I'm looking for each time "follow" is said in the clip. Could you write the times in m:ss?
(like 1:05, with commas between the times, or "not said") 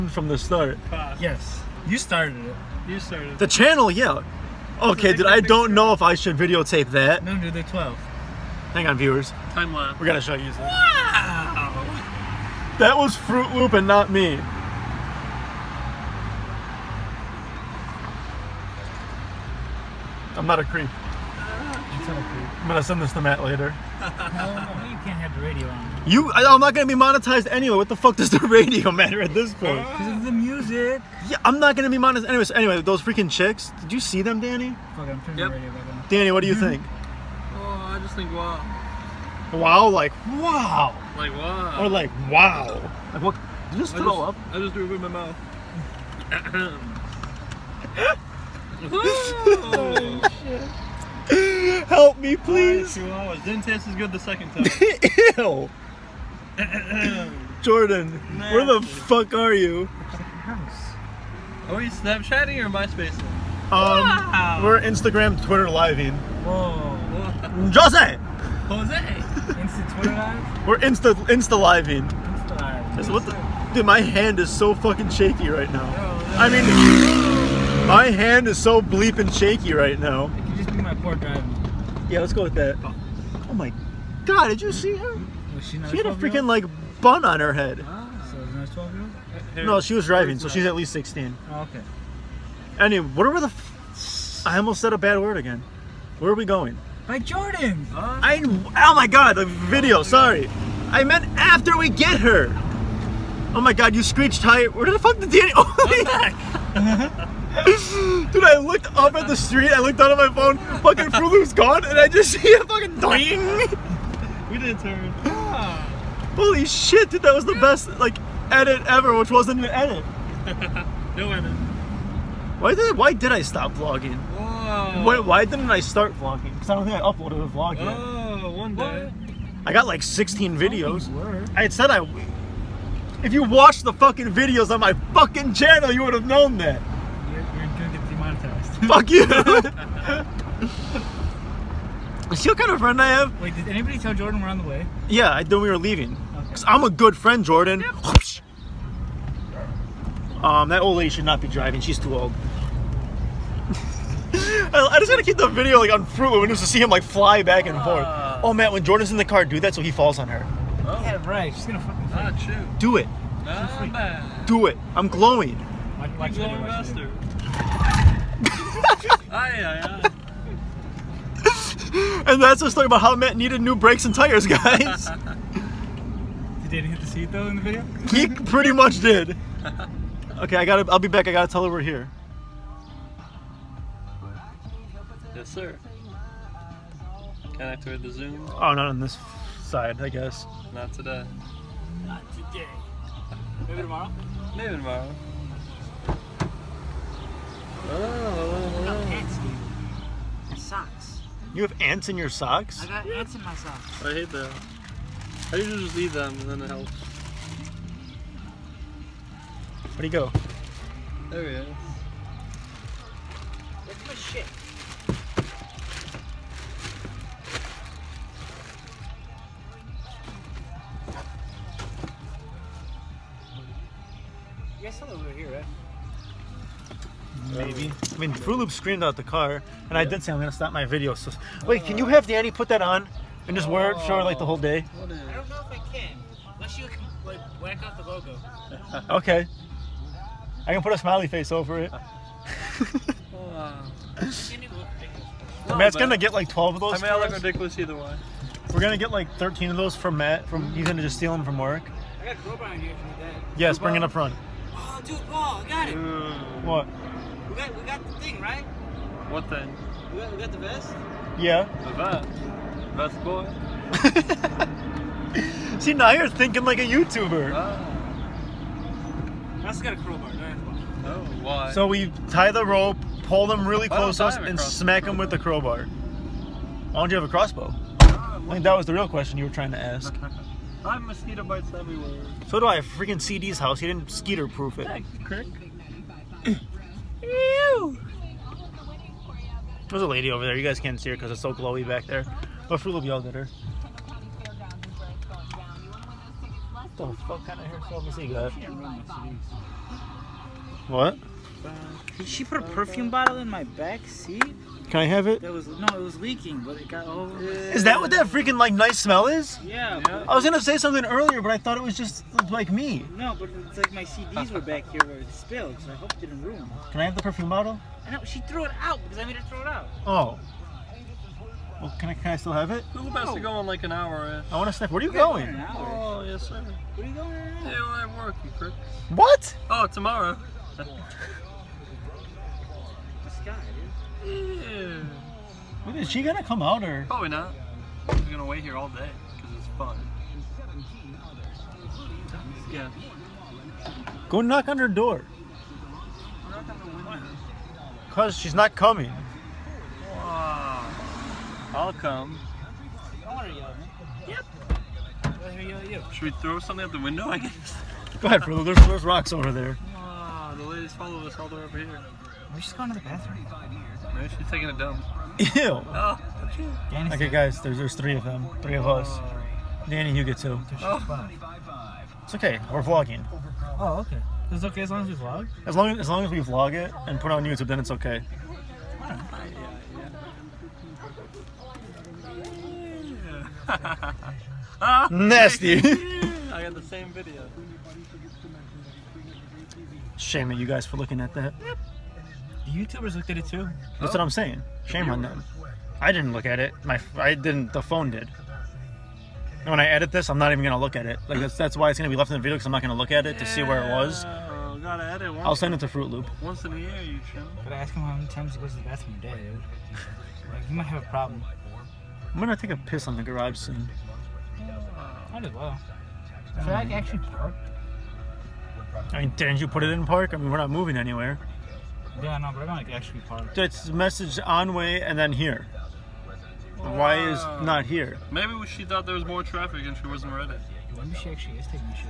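6:00.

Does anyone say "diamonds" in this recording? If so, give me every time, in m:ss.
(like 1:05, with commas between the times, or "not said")
not said.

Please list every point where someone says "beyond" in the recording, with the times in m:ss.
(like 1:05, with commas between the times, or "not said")
not said.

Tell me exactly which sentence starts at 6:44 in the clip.
gotta edit I'll send it to Fruit Loop.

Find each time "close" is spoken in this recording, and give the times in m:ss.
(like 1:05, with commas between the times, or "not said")
4:33.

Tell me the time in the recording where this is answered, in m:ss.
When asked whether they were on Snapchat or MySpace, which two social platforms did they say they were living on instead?
1:04.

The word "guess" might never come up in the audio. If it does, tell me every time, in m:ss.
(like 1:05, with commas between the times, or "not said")
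3:10, 5:57.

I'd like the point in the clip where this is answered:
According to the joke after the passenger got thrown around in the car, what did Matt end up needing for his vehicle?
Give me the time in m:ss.
2:53.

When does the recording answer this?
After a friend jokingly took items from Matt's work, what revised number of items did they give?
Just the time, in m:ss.
4:09.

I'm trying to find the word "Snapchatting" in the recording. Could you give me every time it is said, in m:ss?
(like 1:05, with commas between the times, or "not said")
1:01.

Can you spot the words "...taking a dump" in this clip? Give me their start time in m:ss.
6:04.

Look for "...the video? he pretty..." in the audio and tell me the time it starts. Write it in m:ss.
2:57.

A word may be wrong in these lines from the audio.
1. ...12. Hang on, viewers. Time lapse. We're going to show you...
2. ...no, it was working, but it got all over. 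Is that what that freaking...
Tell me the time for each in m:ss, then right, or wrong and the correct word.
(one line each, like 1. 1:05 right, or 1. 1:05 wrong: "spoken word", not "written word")
1. 0:07 right
2. 5:05 wrong: "leaking", not "working".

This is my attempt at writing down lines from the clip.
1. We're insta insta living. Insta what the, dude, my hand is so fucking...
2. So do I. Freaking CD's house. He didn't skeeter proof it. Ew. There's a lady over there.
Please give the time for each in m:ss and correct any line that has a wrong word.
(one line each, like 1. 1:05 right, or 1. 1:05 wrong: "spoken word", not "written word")
1. 1:10 right
2. 4:42 right.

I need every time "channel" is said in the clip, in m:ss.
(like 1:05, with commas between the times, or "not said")
0:03, 2:15.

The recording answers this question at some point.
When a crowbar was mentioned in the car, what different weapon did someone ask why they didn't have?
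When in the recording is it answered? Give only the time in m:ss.
4:37.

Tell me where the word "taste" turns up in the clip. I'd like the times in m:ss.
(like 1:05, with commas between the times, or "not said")
0:53.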